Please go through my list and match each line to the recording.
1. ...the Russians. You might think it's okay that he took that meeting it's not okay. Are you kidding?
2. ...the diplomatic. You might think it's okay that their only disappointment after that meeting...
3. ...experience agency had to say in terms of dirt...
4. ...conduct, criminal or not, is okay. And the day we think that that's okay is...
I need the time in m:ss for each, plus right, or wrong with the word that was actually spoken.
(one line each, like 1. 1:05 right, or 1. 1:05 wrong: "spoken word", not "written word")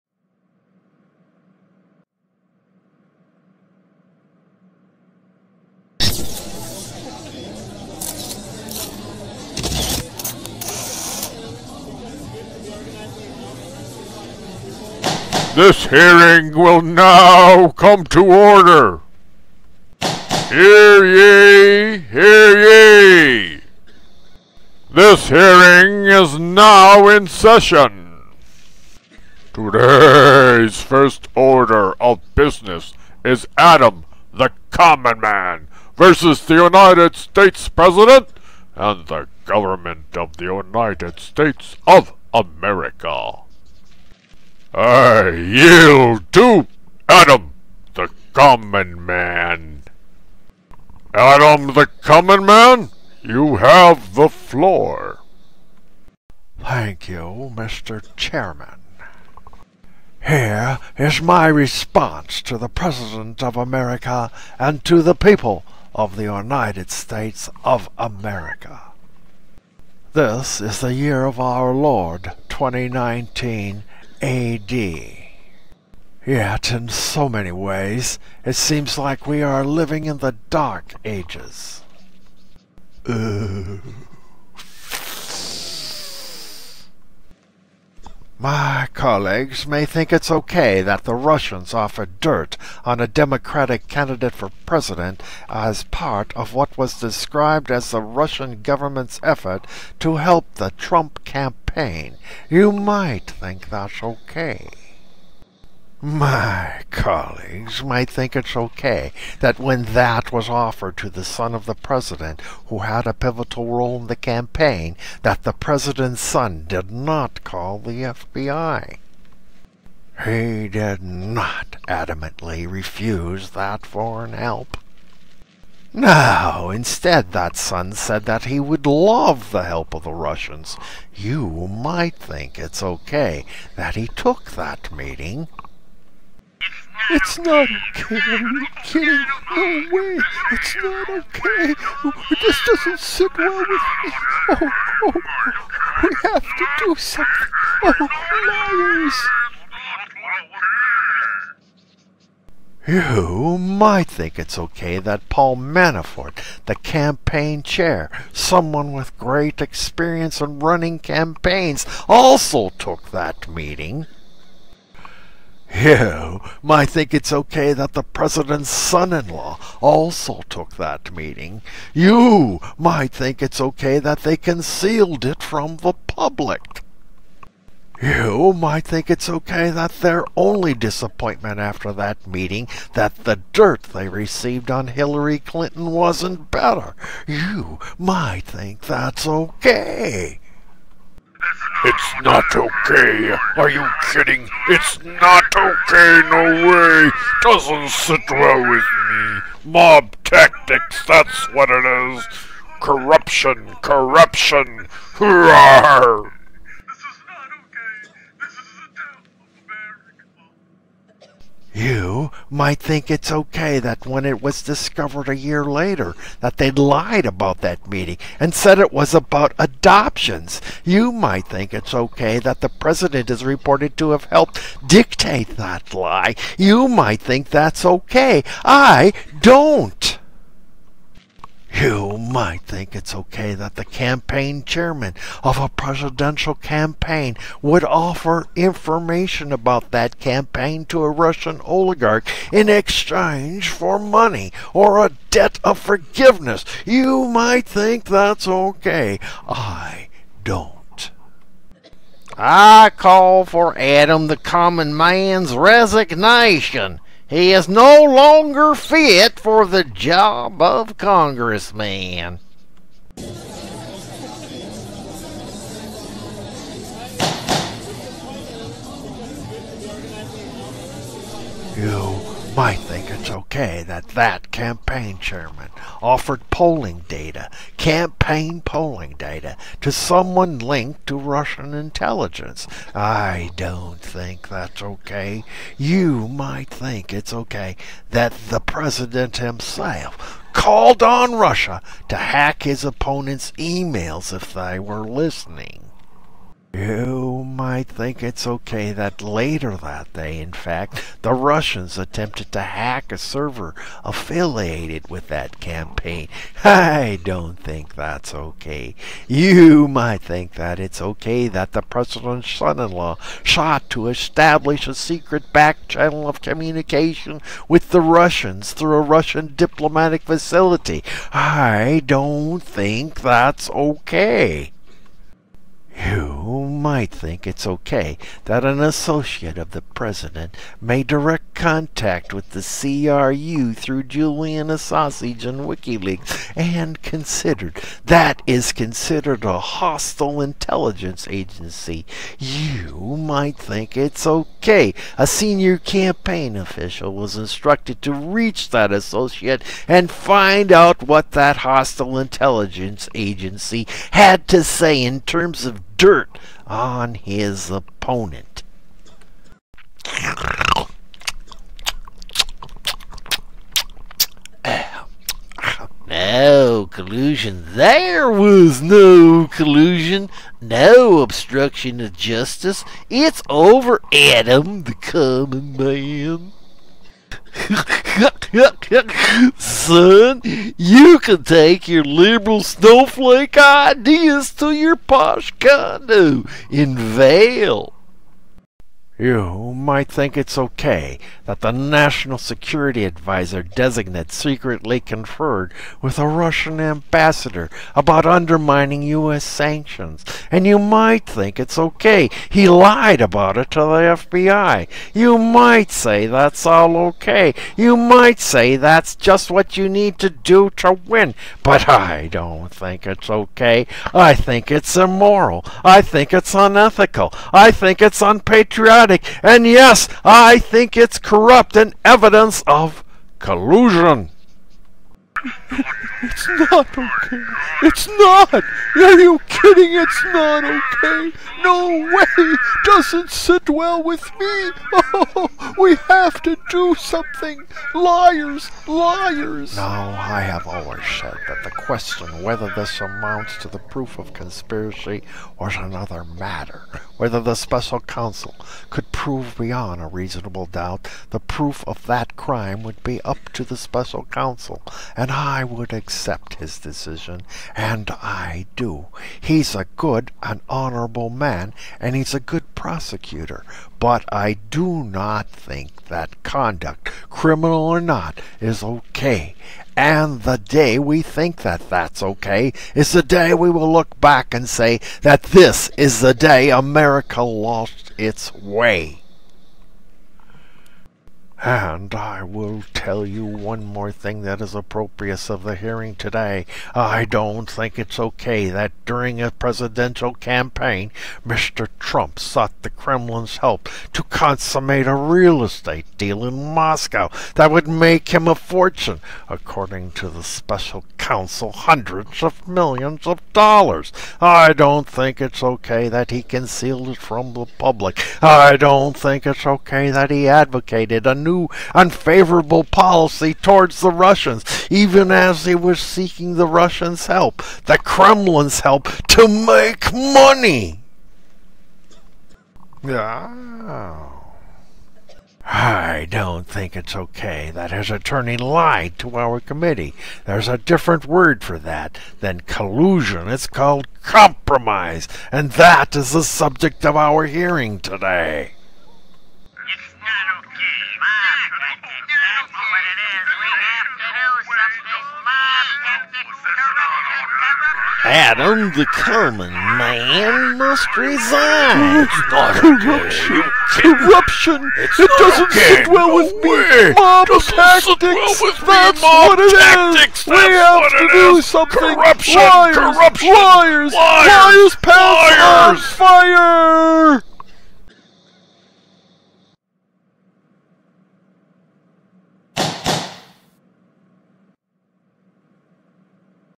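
1. 2:10 right
2. 2:55 wrong: "public", not "diplomatic"
3. 5:52 wrong: "intelligence", not "experience"
4. 7:46 right.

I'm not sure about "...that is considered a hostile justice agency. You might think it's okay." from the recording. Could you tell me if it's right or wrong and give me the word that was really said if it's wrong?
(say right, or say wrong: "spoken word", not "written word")
wrong: "intelligence", not "justice".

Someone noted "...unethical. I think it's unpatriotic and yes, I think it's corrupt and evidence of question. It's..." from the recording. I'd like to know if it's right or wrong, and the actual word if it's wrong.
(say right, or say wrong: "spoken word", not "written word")
wrong: "collusion", not "question".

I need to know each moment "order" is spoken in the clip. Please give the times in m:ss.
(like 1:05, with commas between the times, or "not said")
0:18, 0:31.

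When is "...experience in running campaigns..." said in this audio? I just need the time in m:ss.
2:39.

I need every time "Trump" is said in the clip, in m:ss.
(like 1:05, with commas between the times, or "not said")
1:40, 8:11.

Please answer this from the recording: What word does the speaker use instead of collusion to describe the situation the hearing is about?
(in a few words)
compromise.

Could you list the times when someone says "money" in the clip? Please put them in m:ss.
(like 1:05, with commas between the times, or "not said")
4:03, 8:40.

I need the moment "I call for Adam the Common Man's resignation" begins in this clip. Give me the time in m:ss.
4:12.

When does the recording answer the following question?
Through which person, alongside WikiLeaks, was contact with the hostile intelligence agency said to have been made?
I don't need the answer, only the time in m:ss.
5:34.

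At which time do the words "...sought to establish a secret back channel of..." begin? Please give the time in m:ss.
5:13.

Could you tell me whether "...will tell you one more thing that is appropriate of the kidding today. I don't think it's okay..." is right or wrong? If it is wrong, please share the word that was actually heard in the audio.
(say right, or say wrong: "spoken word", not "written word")
wrong: "hearing", not "kidding".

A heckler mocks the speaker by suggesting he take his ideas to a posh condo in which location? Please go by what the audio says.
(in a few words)
Vail.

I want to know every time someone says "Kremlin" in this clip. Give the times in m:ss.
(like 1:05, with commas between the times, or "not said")
8:12, 8:37.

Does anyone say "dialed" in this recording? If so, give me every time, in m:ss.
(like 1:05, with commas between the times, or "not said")
not said.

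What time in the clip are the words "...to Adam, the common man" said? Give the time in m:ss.
0:46.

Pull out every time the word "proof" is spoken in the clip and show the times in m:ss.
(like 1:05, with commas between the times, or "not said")
7:23, 7:31.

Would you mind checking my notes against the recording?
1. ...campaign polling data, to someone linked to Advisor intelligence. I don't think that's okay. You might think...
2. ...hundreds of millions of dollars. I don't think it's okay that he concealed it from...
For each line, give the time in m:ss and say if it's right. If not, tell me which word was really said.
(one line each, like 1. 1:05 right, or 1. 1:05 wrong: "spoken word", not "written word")
1. 4:37 wrong: "Russian", not "Advisor"
2. 8:21 right.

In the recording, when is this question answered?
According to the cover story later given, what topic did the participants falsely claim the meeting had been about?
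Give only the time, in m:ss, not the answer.
3:39.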